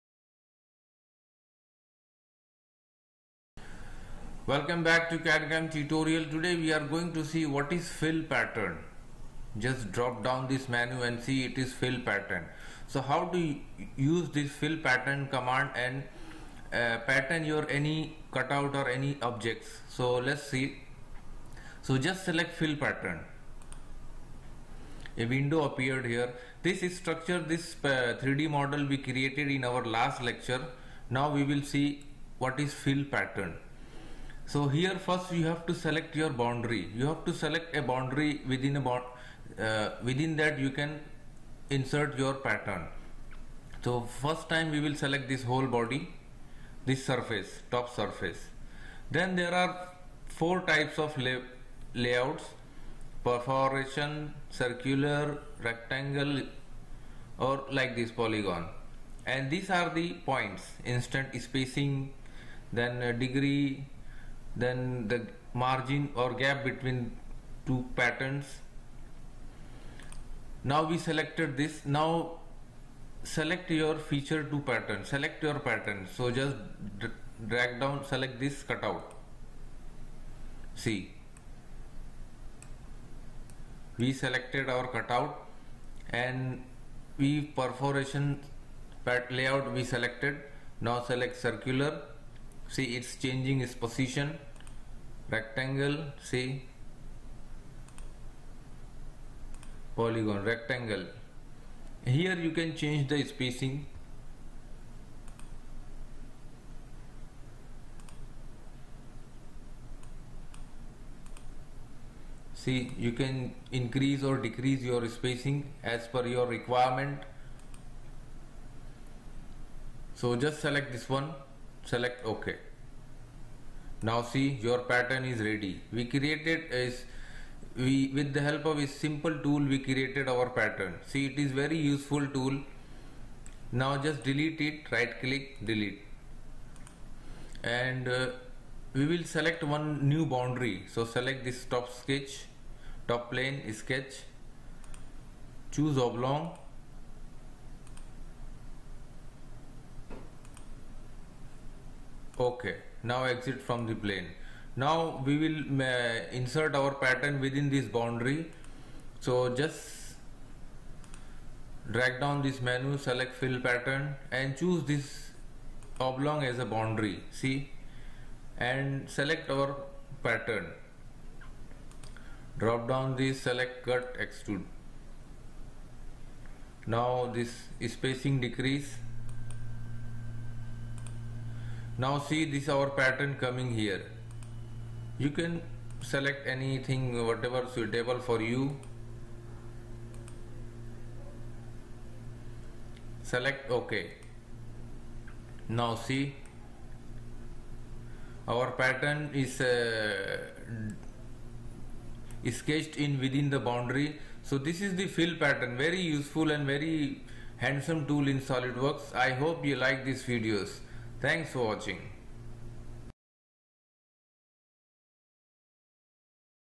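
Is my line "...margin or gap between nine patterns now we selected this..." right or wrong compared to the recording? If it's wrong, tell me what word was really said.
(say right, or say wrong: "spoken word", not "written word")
wrong: "two", not "nine".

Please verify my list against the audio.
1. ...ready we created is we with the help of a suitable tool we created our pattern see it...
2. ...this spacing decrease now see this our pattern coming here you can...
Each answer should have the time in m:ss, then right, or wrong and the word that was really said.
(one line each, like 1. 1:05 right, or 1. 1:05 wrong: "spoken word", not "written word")
1. 2:05 wrong: "simple", not "suitable"
2. 2:57 right.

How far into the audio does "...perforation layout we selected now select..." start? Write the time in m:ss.
1:27.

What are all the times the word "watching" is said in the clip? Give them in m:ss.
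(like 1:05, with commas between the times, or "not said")
3:31.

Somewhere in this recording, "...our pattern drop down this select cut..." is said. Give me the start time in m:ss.
2:49.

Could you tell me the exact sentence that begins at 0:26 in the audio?
This structure, this uh, 3D model we created in our last lecture.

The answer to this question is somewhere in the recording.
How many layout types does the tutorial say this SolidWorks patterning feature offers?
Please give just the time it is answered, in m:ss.
0:50.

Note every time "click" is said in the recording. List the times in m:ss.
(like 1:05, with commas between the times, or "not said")
2:15.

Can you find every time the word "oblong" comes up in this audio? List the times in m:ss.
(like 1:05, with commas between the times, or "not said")
2:25, 2:46.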